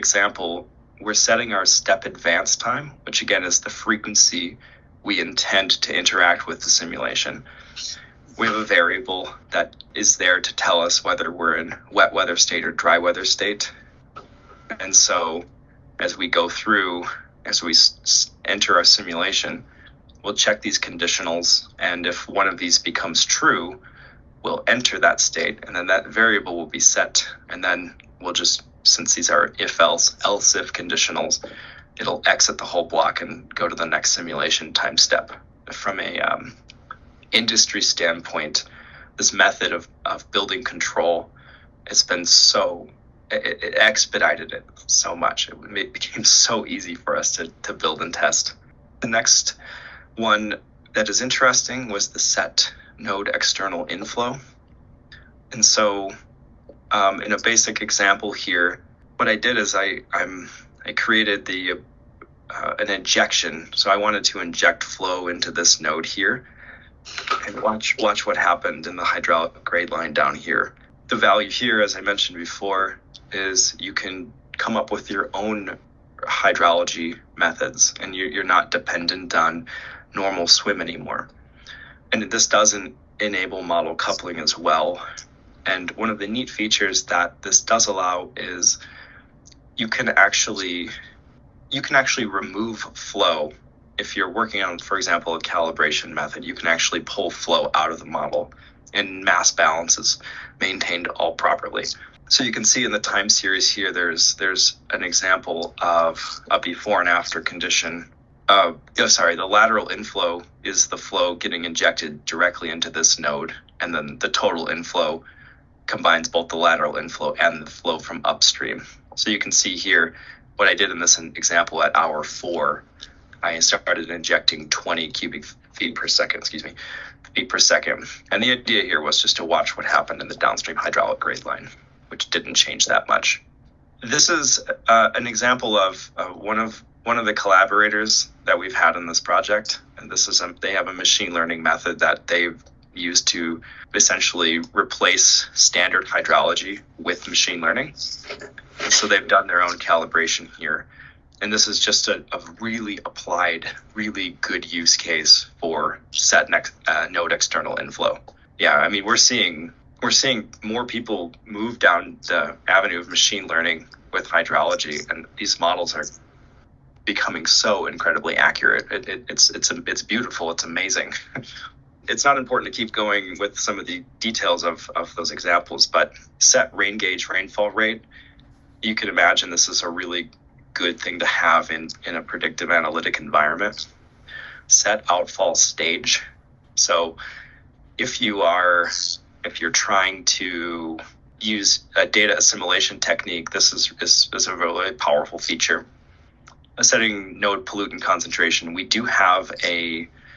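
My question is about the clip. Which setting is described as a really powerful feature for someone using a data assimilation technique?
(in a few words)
Set outfall stage.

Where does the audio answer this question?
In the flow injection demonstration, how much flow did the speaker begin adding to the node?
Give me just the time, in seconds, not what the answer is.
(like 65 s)
124 s.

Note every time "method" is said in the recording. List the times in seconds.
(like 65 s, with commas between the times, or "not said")
39 s, 77 s, 96 s, 141 s.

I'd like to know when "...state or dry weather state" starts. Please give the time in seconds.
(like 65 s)
12 s.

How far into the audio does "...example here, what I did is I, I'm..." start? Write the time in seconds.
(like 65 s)
57 s.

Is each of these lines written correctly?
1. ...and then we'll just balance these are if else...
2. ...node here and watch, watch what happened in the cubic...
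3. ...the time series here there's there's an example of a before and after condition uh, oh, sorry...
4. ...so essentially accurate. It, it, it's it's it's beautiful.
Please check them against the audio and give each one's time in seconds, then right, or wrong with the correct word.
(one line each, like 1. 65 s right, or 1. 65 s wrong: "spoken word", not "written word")
1. 27 s wrong: "since", not "balance"
2. 65 s wrong: "hydraulic", not "cubic"
3. 102 s right
4. 167 s wrong: "incredibly", not "essentially".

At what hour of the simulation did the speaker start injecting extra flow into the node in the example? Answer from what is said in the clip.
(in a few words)
hour 4.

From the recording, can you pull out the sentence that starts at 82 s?
And this doesn't enable model coupling as well.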